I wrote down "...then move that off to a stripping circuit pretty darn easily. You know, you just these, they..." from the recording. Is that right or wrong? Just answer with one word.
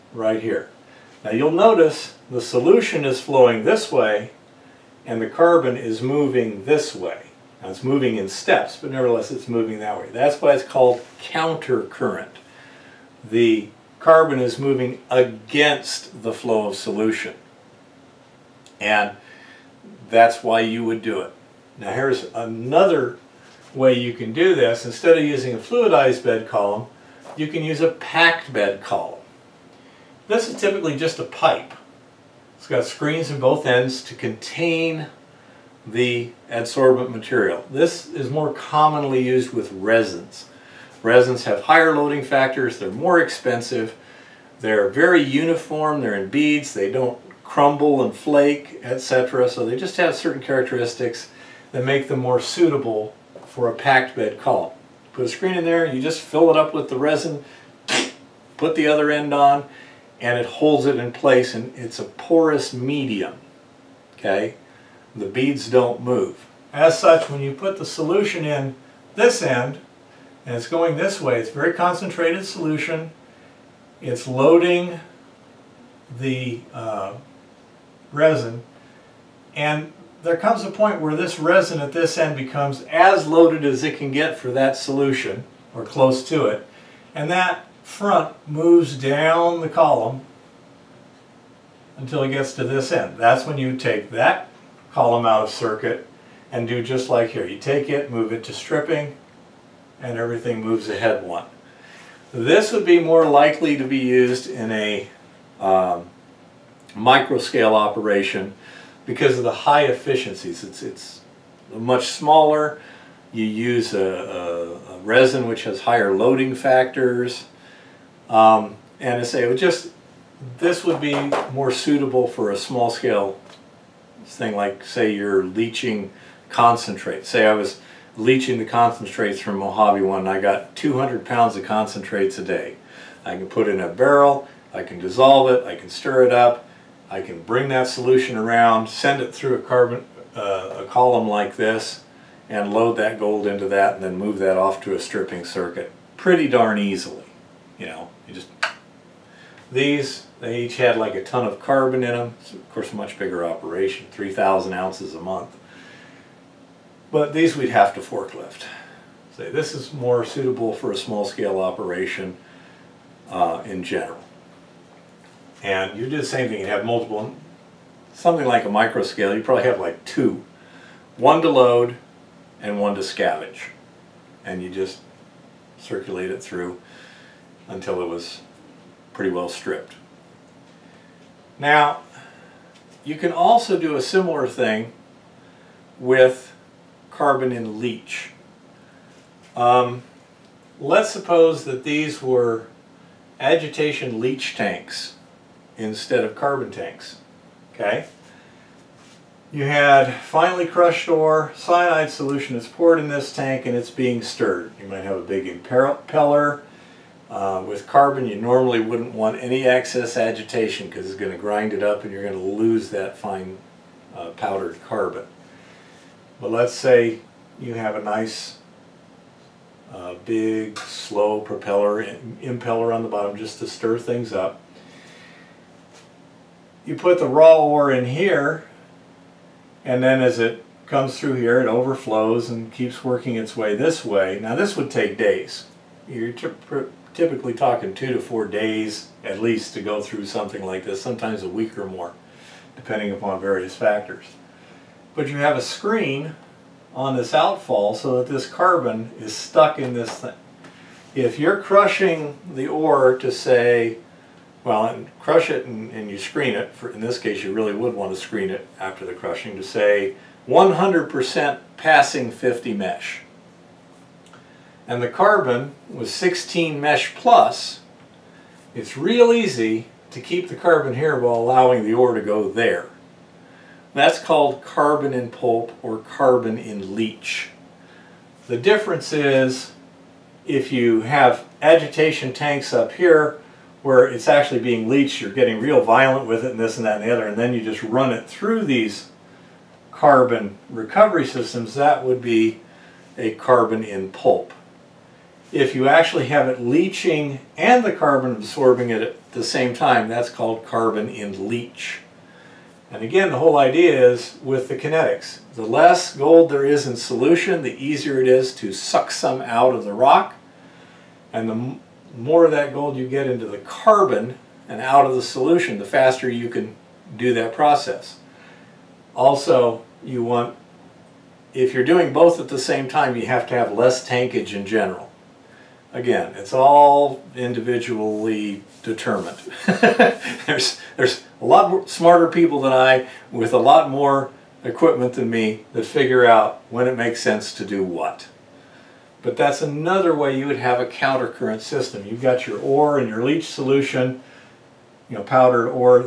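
right.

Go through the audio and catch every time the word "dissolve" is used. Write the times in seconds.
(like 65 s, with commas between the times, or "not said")
134 s.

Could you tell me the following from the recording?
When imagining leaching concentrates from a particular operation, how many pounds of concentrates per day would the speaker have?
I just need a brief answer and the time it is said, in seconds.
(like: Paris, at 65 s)
200 pounds, at 130 s.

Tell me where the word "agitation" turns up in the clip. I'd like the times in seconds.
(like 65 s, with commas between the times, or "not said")
193 s, 210 s, 281 s.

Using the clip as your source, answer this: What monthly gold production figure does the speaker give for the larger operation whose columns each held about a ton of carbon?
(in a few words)
3,000 ounces a month.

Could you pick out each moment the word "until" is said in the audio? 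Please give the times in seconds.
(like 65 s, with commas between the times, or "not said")
91 s, 177 s.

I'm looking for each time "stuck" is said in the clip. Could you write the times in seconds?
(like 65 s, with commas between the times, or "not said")
249 s.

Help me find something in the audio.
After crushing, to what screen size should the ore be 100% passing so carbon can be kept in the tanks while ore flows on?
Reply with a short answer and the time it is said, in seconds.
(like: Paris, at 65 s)
50 mesh, at 262 s.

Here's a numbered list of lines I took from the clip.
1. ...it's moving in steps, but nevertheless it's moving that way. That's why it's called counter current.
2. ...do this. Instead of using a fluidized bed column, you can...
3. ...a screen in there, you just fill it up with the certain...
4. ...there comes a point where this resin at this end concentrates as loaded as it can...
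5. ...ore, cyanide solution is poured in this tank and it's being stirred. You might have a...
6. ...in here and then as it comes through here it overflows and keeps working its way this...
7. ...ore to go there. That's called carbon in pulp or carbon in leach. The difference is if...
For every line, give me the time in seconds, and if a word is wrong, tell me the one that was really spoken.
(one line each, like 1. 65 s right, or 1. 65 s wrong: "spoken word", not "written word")
1. 7 s right
2. 24 s right
3. 55 s wrong: "resin", not "certain"
4. 80 s wrong: "becomes", not "concentrates"
5. 201 s right
6. 227 s right
7. 271 s right.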